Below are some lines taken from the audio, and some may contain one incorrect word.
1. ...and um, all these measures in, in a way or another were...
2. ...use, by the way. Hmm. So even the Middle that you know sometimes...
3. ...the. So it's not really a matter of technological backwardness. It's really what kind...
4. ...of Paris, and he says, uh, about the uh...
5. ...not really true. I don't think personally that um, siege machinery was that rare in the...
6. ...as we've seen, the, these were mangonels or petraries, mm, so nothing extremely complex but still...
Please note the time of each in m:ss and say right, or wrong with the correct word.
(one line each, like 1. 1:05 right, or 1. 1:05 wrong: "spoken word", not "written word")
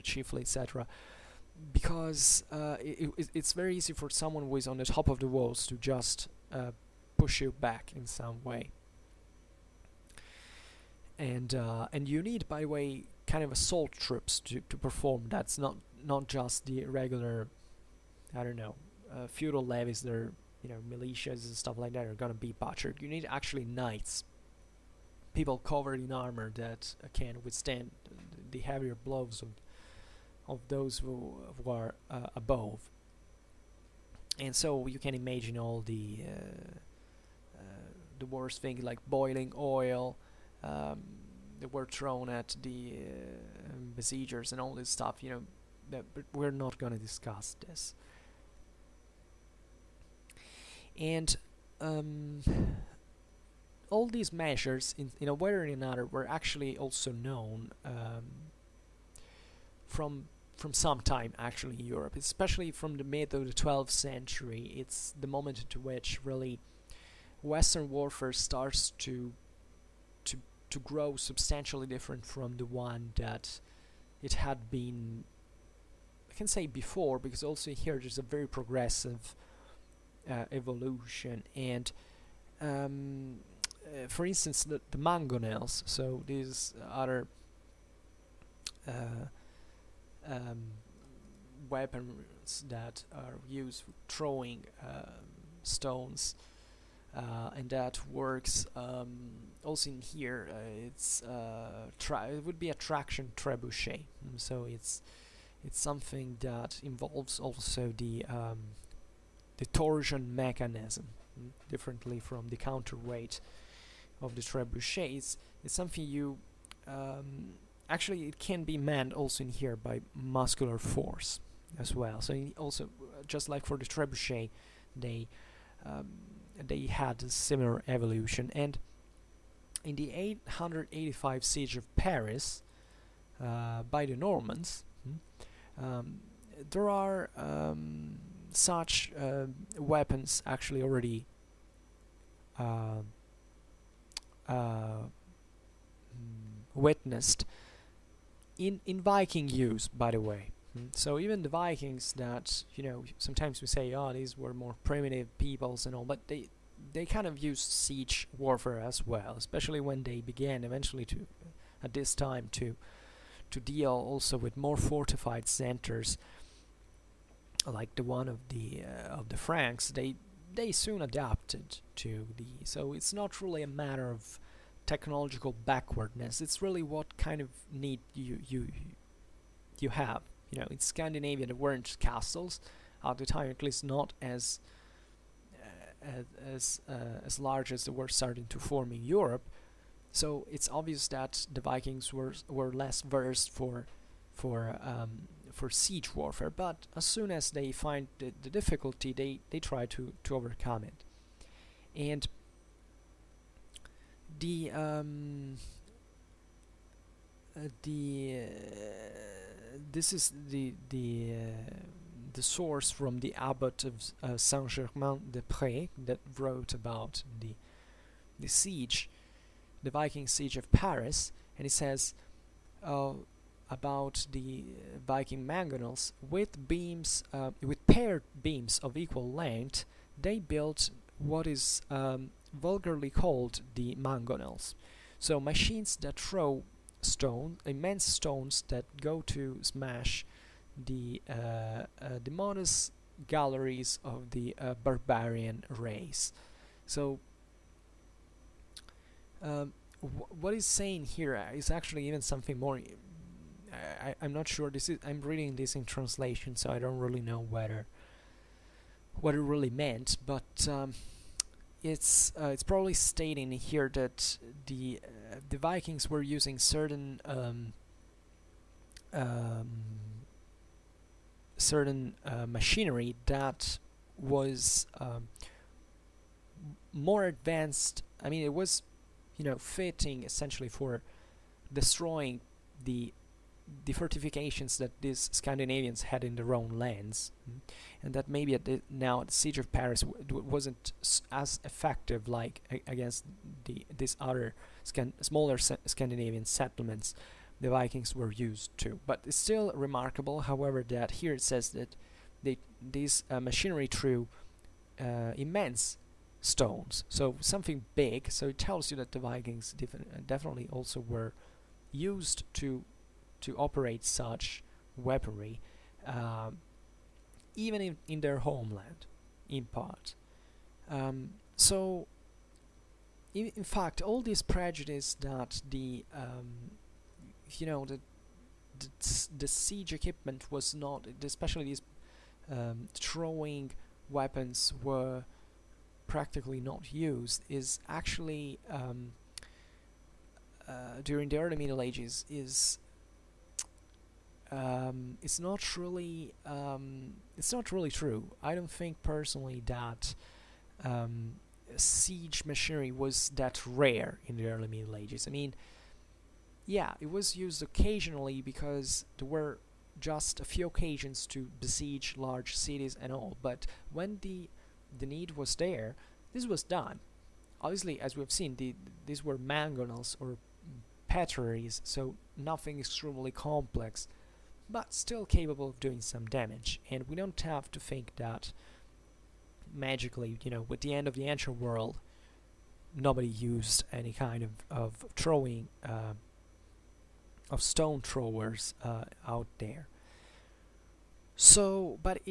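1. 0:50 right
2. 2:29 wrong: "Vikings", not "Middle"
3. 2:52 right
4. 3:40 right
5. 5:47 right
6. 6:08 right.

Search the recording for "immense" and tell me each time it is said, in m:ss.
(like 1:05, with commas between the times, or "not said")
3:57, 5:05.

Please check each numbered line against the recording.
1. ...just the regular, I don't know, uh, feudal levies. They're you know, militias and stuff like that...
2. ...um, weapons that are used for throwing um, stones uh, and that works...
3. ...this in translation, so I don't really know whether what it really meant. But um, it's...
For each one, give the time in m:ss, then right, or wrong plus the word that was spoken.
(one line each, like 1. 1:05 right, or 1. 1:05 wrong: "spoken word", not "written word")
1. 0:16 right
2. 1:30 right
3. 4:15 right.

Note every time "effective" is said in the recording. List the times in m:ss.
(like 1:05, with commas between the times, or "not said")
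4:51.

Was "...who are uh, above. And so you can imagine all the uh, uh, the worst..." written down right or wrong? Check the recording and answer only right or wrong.
right.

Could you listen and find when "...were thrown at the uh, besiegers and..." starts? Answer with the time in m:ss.
0:41.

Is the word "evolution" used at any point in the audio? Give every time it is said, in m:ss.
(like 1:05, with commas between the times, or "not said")
1:20, 2:07.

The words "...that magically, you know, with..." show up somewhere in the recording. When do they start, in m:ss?
6:18.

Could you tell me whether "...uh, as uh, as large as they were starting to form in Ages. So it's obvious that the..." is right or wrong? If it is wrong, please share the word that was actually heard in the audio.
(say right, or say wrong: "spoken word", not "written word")
wrong: "Europe", not "Ages".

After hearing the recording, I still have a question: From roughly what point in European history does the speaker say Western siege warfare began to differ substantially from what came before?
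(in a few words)
mid 12th century.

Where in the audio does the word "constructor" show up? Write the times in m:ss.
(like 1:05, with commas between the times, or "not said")
not said.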